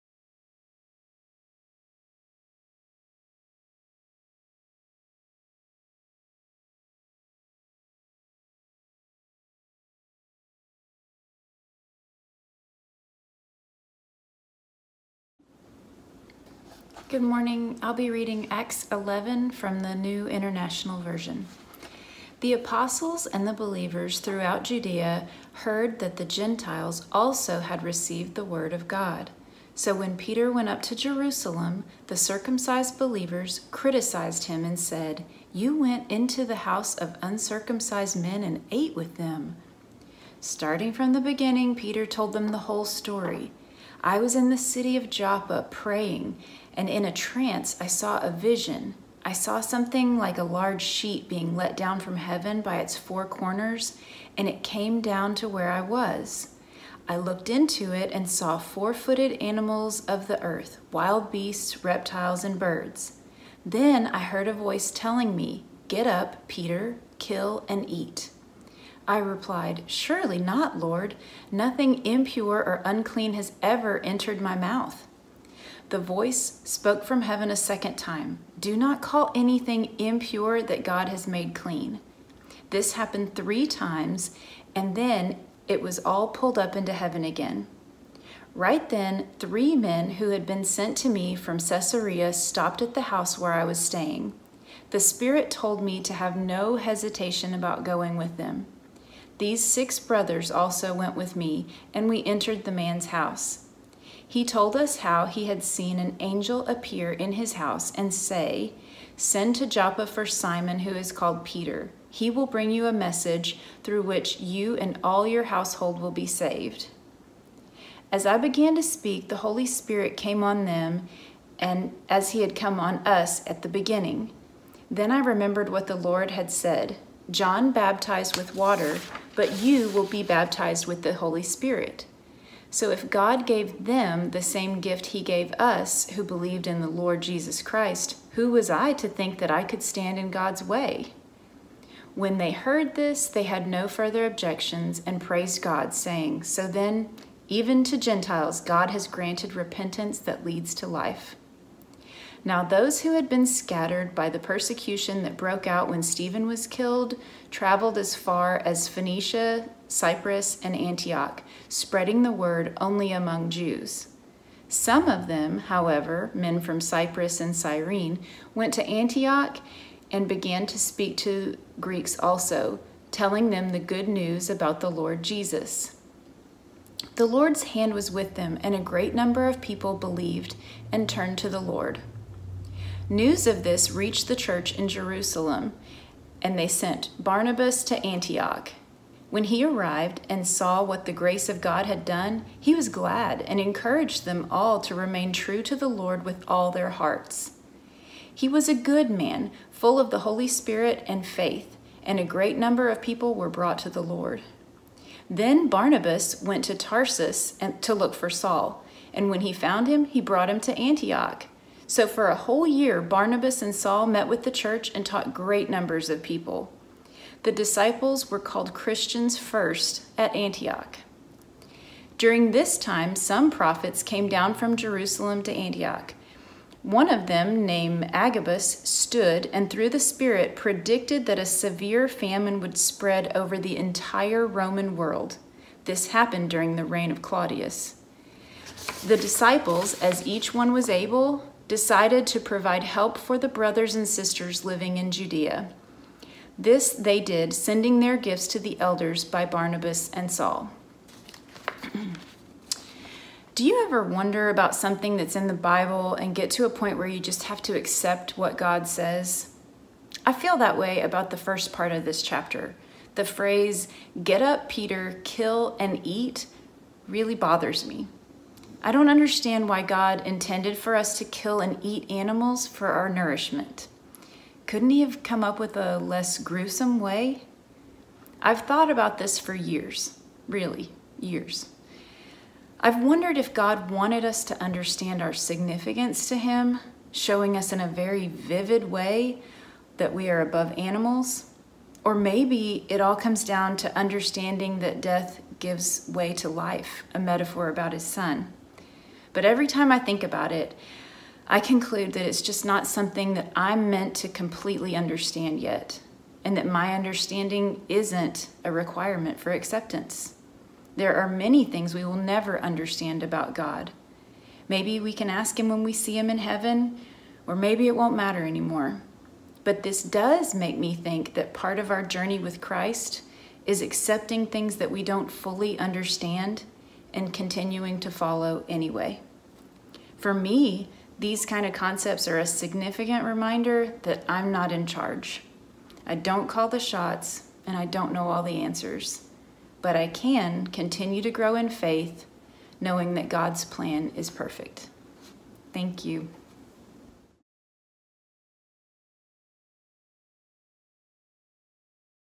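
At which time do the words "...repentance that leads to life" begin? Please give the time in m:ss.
2:29.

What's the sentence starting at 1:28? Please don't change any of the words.
Right then, three men who had been sent to me from Caesarea stopped at the house where I was staying.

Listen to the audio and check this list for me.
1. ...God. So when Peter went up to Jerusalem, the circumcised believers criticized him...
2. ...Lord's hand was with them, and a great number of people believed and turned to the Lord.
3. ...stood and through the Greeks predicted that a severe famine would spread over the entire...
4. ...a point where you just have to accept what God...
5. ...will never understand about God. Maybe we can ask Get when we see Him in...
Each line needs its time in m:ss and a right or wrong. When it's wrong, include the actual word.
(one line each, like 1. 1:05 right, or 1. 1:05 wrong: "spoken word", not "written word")
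1. 0:28 right
2. 2:57 right
3. 3:48 wrong: "Spirit", not "Greeks"
4. 4:16 right
5. 5:12 wrong: "Him", not "Get".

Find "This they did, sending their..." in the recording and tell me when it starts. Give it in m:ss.
4:06.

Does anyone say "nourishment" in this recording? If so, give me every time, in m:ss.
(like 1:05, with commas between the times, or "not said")
4:33.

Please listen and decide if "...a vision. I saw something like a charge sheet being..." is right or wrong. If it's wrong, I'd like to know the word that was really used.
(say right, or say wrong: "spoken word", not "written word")
wrong: "large", not "charge".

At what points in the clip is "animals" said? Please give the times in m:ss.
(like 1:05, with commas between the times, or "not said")
0:59, 4:32, 4:50.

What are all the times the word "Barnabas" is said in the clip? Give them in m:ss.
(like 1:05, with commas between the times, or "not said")
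3:07, 3:25, 3:33, 4:09.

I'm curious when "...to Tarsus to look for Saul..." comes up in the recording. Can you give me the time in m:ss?
3:26.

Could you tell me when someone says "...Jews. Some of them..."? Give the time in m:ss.
2:43.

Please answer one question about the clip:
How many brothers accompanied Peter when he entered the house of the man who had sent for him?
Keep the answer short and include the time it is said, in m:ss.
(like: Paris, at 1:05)
6, at 1:39.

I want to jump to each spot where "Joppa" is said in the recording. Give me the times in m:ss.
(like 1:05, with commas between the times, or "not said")
0:45, 1:49.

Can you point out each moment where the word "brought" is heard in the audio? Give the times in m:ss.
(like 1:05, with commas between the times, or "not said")
3:23, 3:30.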